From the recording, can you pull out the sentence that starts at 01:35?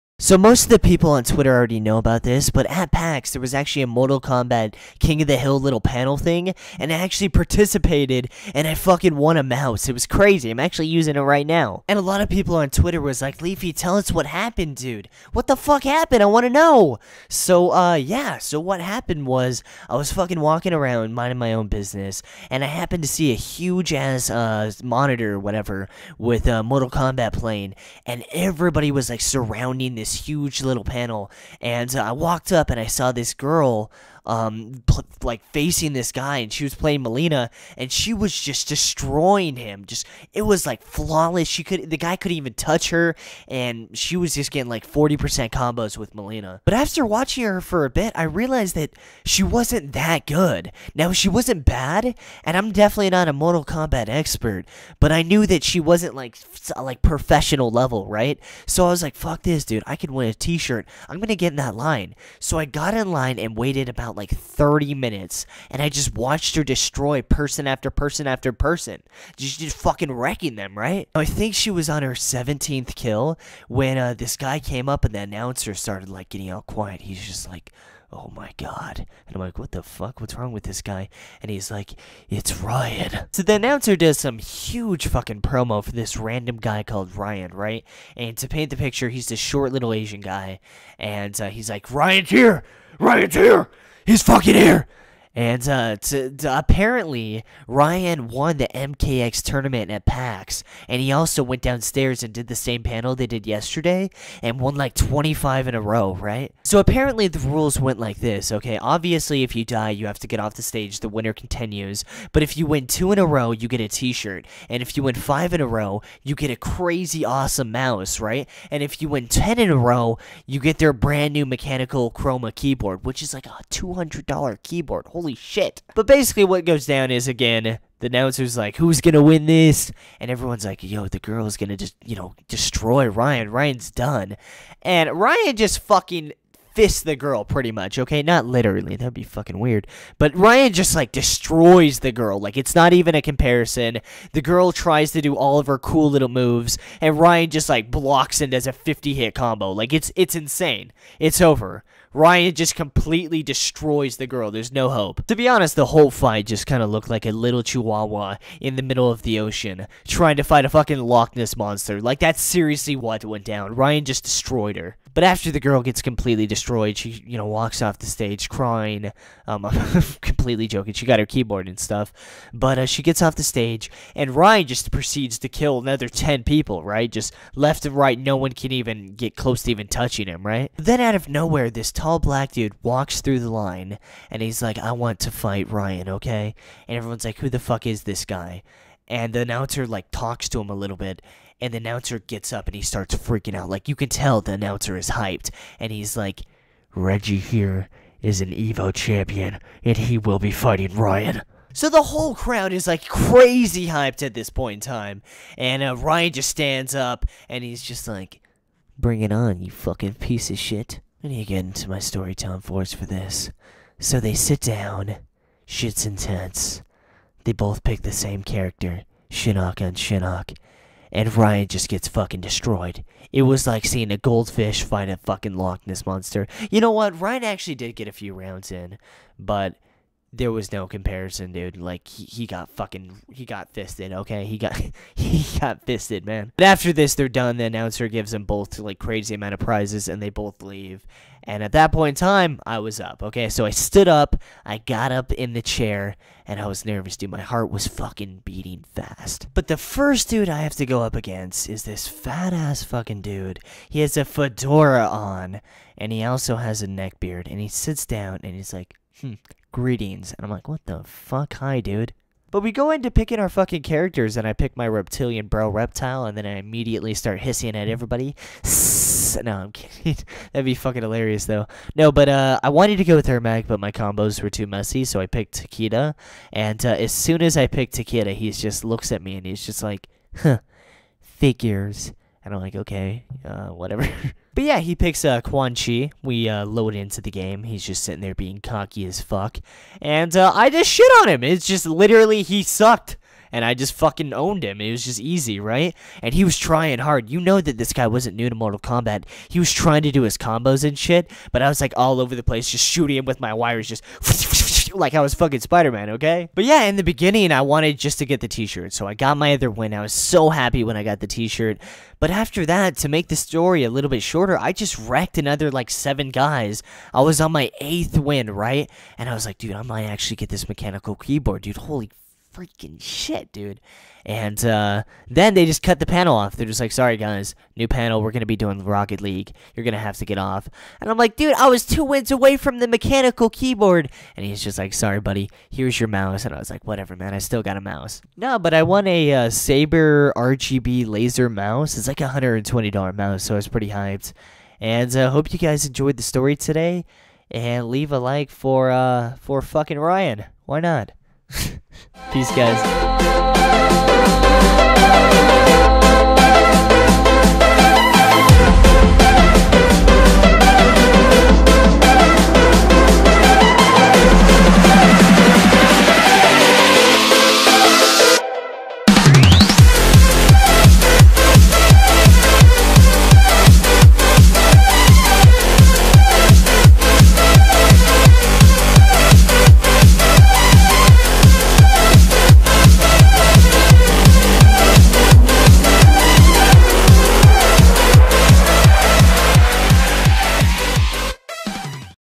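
And uh, to, to, apparently, Ryan won the MKX tournament at PAX.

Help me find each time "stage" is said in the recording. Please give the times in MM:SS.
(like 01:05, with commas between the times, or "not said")
01:50, 02:48, 02:53.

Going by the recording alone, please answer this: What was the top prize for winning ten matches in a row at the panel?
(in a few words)
mechanical chroma keyboard.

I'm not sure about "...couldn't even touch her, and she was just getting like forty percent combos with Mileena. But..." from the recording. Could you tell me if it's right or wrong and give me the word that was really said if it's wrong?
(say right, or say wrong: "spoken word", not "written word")
right.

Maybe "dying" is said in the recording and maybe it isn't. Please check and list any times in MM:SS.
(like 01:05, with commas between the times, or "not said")
not said.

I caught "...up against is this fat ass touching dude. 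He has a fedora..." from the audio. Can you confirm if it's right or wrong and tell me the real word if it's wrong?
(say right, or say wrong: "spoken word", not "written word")
wrong: "fucking", not "touching".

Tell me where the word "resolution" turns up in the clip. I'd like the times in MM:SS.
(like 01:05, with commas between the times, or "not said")
not said.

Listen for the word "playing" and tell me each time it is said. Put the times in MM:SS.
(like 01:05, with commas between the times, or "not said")
00:27, 00:36.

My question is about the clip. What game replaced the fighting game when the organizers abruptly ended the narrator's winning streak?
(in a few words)
Rocket League.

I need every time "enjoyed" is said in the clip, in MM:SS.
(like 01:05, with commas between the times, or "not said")
05:45.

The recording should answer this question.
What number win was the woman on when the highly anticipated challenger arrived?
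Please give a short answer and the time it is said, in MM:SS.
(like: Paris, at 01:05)
17th, at 01:12.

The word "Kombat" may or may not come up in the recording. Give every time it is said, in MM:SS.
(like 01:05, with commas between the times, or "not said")
00:04, 00:26, 00:53, 04:58.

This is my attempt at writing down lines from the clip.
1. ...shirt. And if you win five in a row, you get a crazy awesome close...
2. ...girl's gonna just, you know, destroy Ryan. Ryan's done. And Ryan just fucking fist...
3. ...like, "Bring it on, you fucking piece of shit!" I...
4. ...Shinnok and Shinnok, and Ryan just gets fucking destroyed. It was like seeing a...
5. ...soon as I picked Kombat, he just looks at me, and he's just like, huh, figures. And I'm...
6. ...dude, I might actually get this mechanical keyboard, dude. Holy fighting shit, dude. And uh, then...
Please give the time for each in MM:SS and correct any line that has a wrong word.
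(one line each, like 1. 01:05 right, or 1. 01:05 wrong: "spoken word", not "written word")
1. 01:54 wrong: "mouse", not "close"
2. 02:11 right
3. 03:28 right
4. 03:39 right
5. 04:37 wrong: "Takeda", not "Kombat"
6. 05:19 wrong: "freaking", not "fighting".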